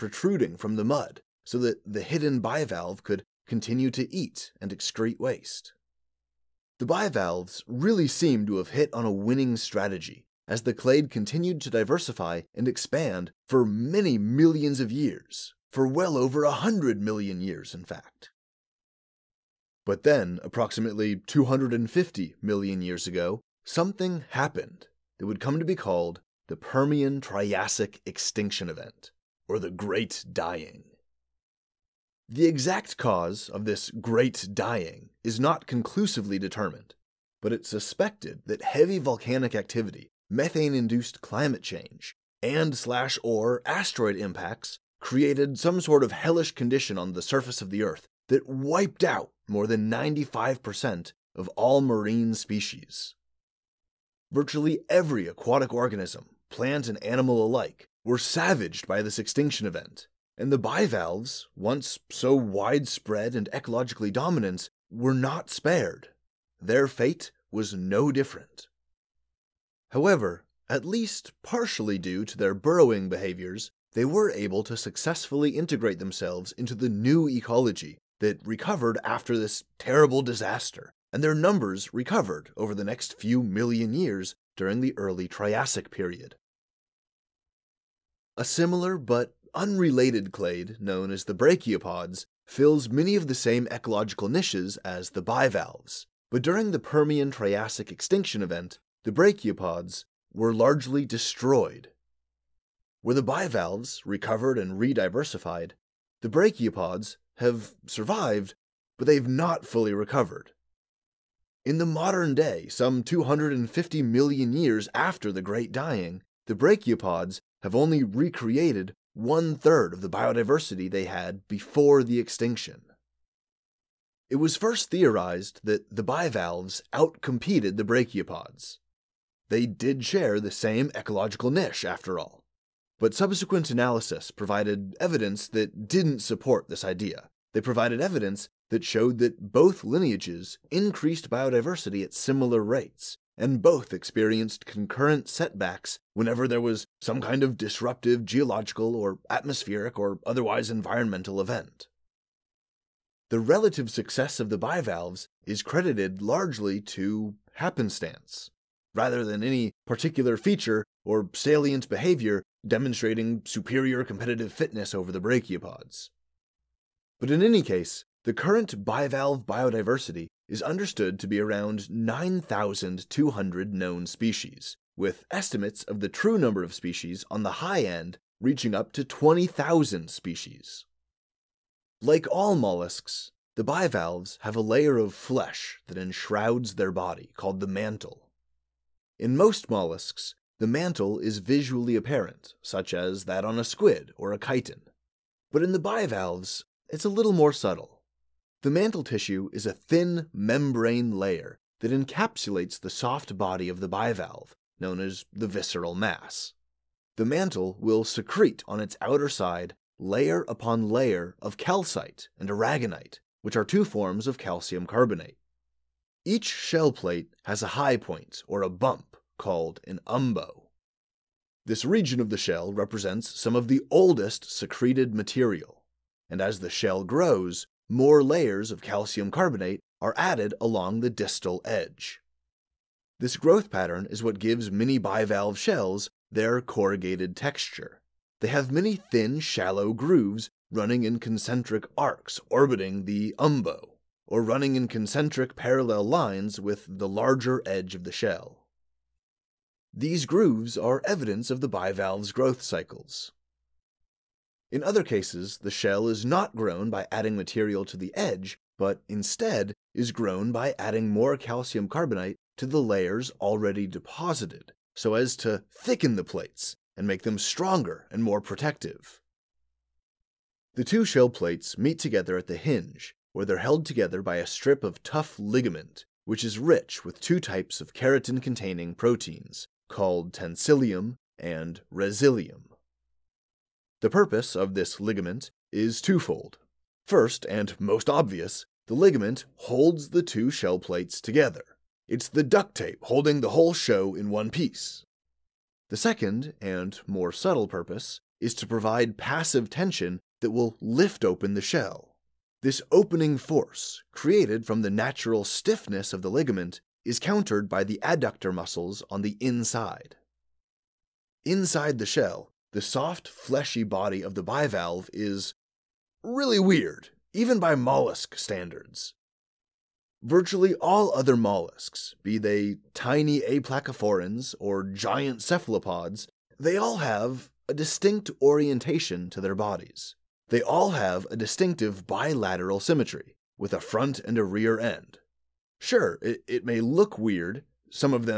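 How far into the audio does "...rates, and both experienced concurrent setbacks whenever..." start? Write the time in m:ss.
2:22.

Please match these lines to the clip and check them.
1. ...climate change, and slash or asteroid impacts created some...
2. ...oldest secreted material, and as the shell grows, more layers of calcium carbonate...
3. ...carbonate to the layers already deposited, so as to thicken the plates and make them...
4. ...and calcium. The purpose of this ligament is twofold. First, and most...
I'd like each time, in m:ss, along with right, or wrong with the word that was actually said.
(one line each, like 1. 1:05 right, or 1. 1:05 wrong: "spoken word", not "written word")
1. 0:41 right
2. 3:43 right
3. 4:21 right
4. 4:41 wrong: "resilium", not "calcium".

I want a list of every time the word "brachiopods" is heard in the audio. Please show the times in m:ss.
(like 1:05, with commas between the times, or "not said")
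1:31, 1:39, 1:46, 1:56, 2:07, 2:45.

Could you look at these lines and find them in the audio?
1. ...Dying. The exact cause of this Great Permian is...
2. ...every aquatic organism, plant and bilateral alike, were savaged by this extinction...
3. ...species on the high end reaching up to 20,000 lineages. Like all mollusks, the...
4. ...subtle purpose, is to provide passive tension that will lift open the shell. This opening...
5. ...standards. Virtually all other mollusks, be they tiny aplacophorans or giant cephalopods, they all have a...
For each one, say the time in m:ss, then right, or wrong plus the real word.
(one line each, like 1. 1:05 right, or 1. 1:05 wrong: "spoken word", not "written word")
1. 0:30 wrong: "Dying", not "Permian"
2. 0:54 wrong: "animal", not "bilateral"
3. 2:56 wrong: "species", not "lineages"
4. 4:57 right
5. 5:18 right.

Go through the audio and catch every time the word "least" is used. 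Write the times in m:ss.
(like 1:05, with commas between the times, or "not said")
1:10.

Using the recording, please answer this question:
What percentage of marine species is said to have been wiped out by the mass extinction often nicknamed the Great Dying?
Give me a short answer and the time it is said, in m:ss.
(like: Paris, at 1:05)
more than 95%, at 0:49.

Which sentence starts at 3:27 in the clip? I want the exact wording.
The mantle will secrete on its outer side layer upon layer of calcite and aragonite, which are two forms of calcium carbonate.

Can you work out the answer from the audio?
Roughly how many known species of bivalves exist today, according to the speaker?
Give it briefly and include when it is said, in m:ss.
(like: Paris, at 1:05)
9,200, at 2:51.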